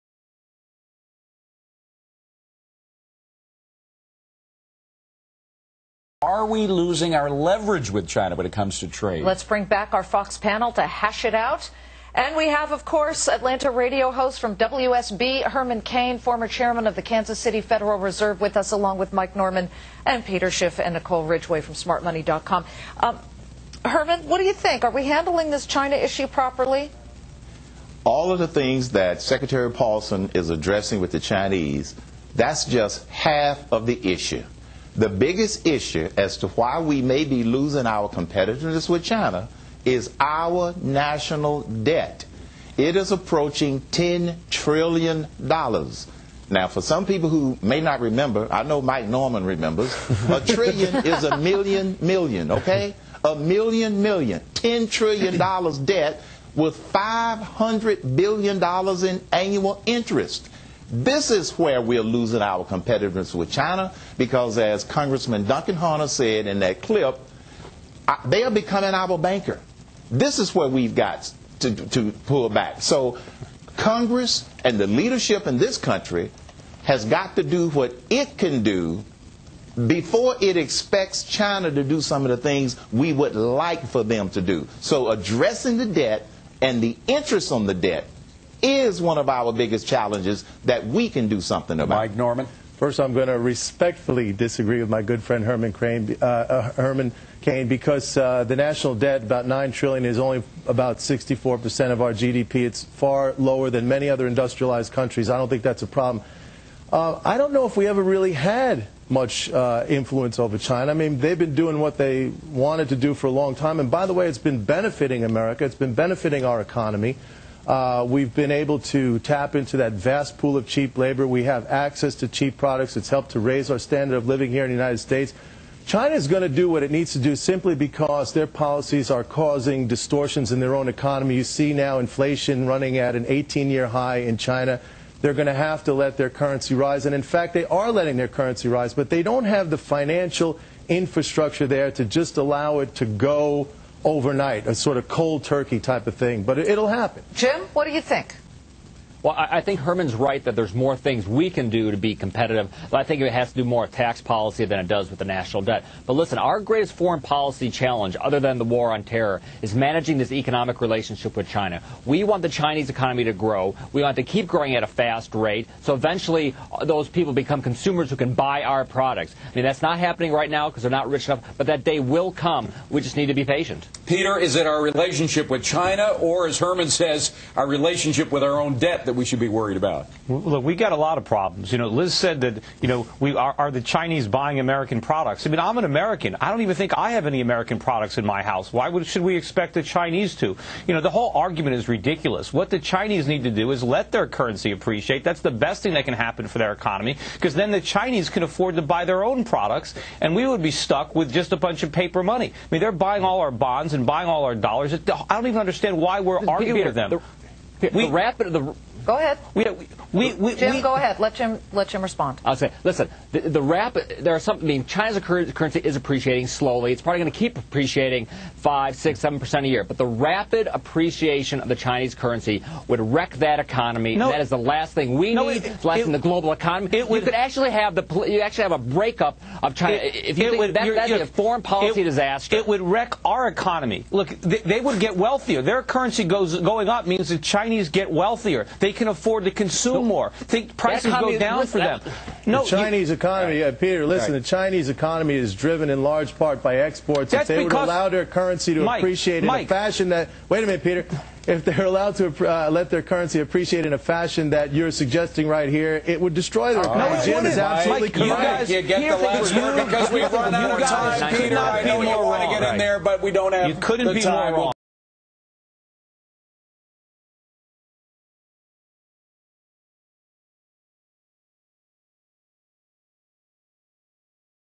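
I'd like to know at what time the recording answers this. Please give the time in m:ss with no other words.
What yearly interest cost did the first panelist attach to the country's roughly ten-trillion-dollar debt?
0:56.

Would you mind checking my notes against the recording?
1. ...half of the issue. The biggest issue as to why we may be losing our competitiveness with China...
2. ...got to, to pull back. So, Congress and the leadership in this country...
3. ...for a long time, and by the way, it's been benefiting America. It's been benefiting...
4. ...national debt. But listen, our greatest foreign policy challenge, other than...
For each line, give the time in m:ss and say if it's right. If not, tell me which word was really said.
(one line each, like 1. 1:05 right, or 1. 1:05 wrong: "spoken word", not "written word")
1. 0:33 right
2. 1:10 right
3. 1:53 right
4. 2:35 right.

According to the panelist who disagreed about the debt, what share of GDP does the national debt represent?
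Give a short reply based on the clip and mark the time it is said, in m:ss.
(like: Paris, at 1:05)
64 percent, at 1:40.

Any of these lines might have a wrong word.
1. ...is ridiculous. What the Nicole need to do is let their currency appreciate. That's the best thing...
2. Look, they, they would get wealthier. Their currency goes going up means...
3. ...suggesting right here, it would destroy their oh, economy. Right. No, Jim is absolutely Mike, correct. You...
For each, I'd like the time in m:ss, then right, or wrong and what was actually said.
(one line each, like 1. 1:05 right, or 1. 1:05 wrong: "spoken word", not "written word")
1. 3:11 wrong: "Chinese", not "Nicole"
2. 3:54 right
3. 4:14 right.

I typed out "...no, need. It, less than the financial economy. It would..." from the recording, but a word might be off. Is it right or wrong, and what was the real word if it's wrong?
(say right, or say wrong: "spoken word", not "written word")
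wrong: "global", not "financial".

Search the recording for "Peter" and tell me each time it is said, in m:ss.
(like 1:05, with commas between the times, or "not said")
0:20, 2:54, 4:03, 4:10, 4:21.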